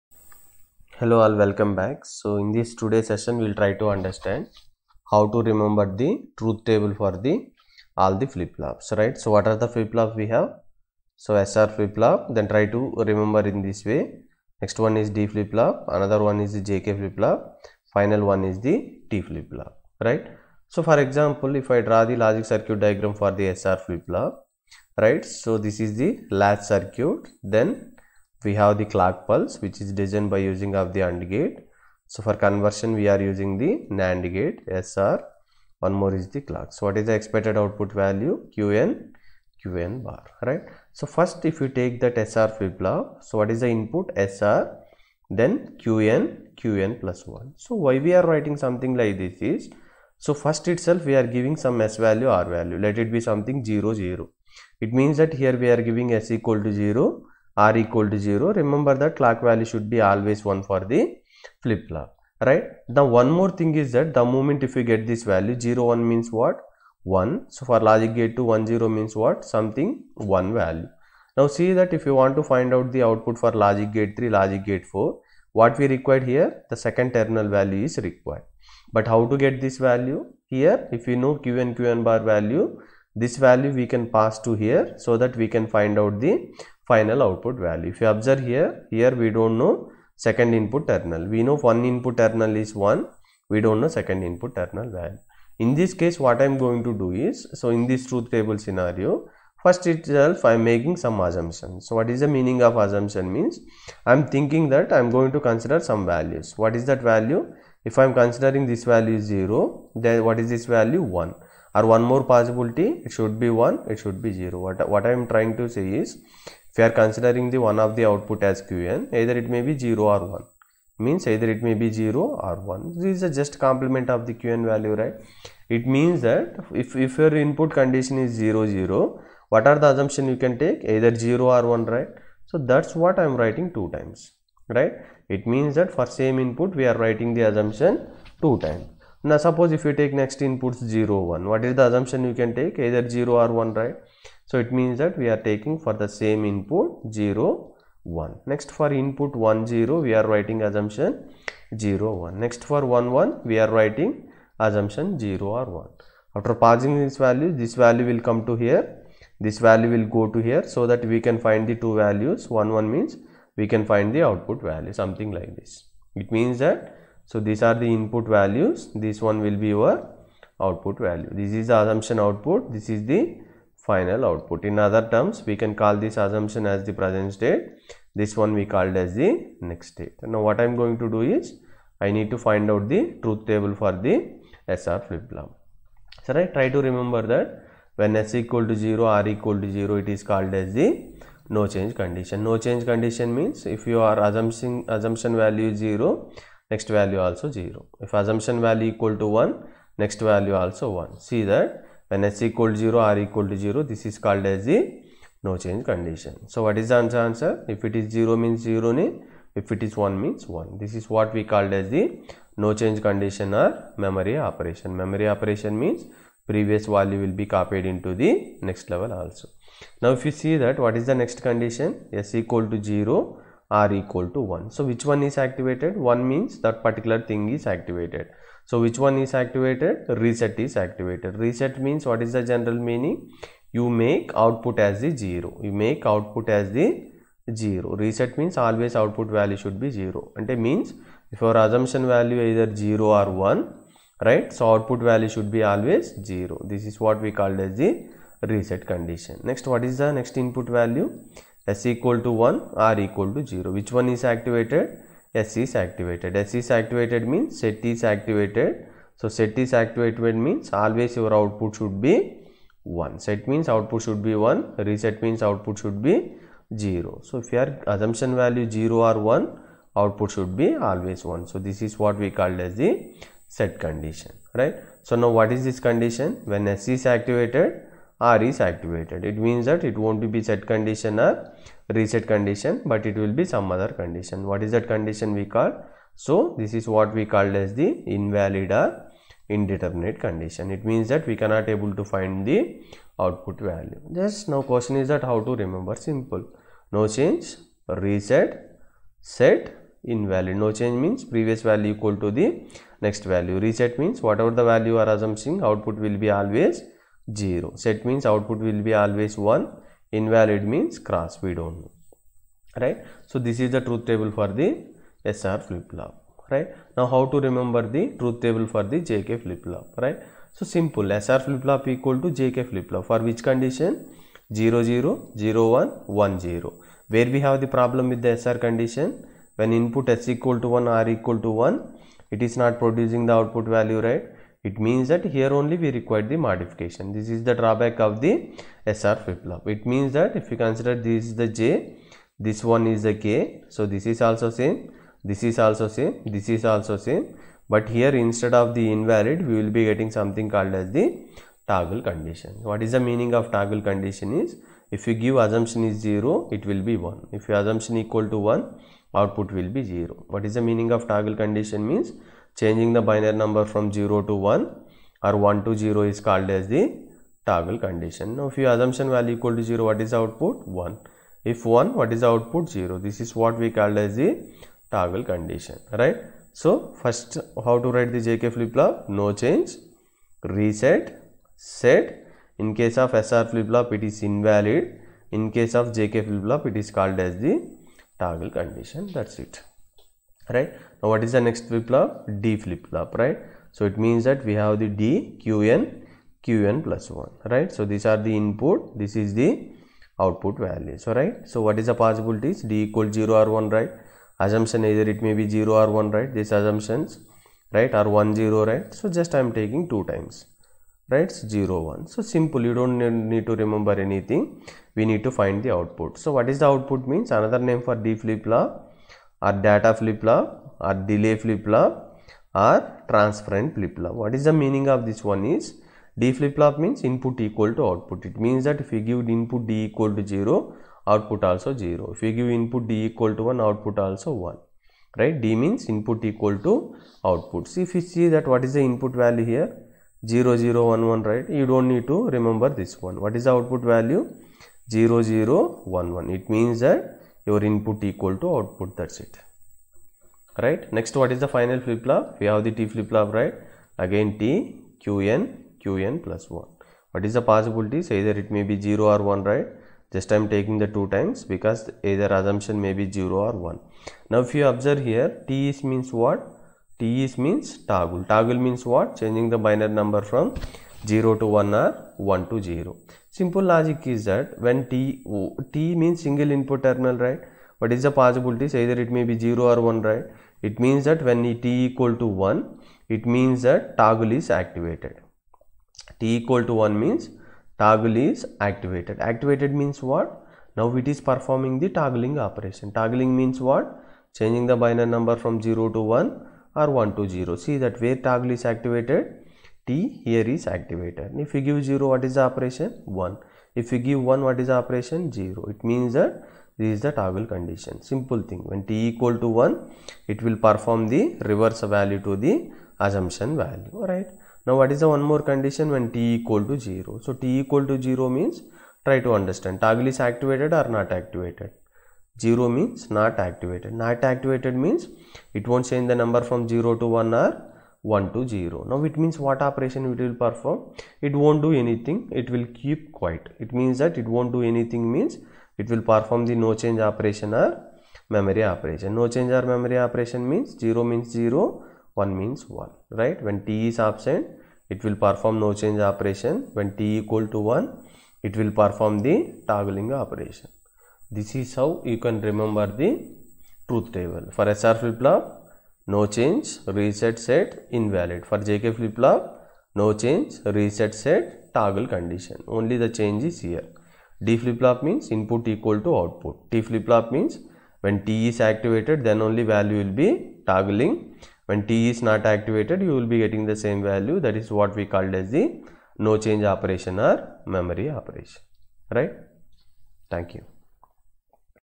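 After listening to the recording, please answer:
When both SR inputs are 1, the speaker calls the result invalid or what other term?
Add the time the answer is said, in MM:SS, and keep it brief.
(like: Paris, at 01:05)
indeterminate, at 04:49.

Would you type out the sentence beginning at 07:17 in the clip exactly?
See if you see that what is the input value here?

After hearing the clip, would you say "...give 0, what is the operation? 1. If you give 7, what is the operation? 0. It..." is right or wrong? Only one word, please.
wrong.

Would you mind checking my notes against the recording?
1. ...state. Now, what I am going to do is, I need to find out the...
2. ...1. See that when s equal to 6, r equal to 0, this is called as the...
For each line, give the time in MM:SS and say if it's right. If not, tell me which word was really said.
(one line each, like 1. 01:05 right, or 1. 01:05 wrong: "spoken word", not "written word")
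1. 02:59 right
2. 03:21 wrong: "0", not "6".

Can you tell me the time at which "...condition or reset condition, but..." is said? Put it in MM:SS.
04:40.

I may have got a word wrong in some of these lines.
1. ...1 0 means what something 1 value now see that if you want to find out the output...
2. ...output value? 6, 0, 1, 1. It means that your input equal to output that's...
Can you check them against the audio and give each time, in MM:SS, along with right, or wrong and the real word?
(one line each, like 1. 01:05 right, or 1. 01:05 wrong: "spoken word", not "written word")
1. 01:08 right
2. 07:23 wrong: "0", not "6".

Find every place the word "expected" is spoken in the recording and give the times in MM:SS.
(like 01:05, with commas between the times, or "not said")
00:37.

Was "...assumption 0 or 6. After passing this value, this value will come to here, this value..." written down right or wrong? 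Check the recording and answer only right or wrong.
wrong.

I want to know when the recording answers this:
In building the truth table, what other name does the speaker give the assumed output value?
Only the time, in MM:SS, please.
02:56.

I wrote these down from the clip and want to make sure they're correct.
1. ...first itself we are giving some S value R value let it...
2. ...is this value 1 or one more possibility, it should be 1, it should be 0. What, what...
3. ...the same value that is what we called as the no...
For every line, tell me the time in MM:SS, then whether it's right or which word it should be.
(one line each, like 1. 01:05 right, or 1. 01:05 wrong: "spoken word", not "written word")
1. 00:50 right
2. 01:50 right
3. 09:33 right.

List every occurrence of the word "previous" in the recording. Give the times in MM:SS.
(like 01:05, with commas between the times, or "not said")
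03:36, 05:01.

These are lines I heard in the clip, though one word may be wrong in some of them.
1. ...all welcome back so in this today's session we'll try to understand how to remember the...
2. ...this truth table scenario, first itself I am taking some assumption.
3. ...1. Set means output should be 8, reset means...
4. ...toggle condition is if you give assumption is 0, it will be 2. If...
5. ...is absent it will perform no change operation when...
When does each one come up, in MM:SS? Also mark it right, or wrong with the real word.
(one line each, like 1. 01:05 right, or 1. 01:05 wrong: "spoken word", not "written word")
1. 00:01 right
2. 01:37 wrong: "making", not "taking"
3. 04:23 wrong: "1", not "8"
4. 05:53 wrong: "1", not "2"
5. 09:03 right.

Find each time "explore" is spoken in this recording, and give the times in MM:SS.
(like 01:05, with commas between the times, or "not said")
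not said.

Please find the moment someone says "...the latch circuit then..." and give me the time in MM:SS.
00:26.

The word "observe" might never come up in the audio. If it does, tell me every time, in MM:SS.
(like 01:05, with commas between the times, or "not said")
01:28, 07:44.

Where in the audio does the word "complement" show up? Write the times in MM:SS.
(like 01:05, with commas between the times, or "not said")
02:03.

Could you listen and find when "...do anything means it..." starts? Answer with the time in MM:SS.
08:54.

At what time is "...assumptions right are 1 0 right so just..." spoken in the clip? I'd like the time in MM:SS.
06:46.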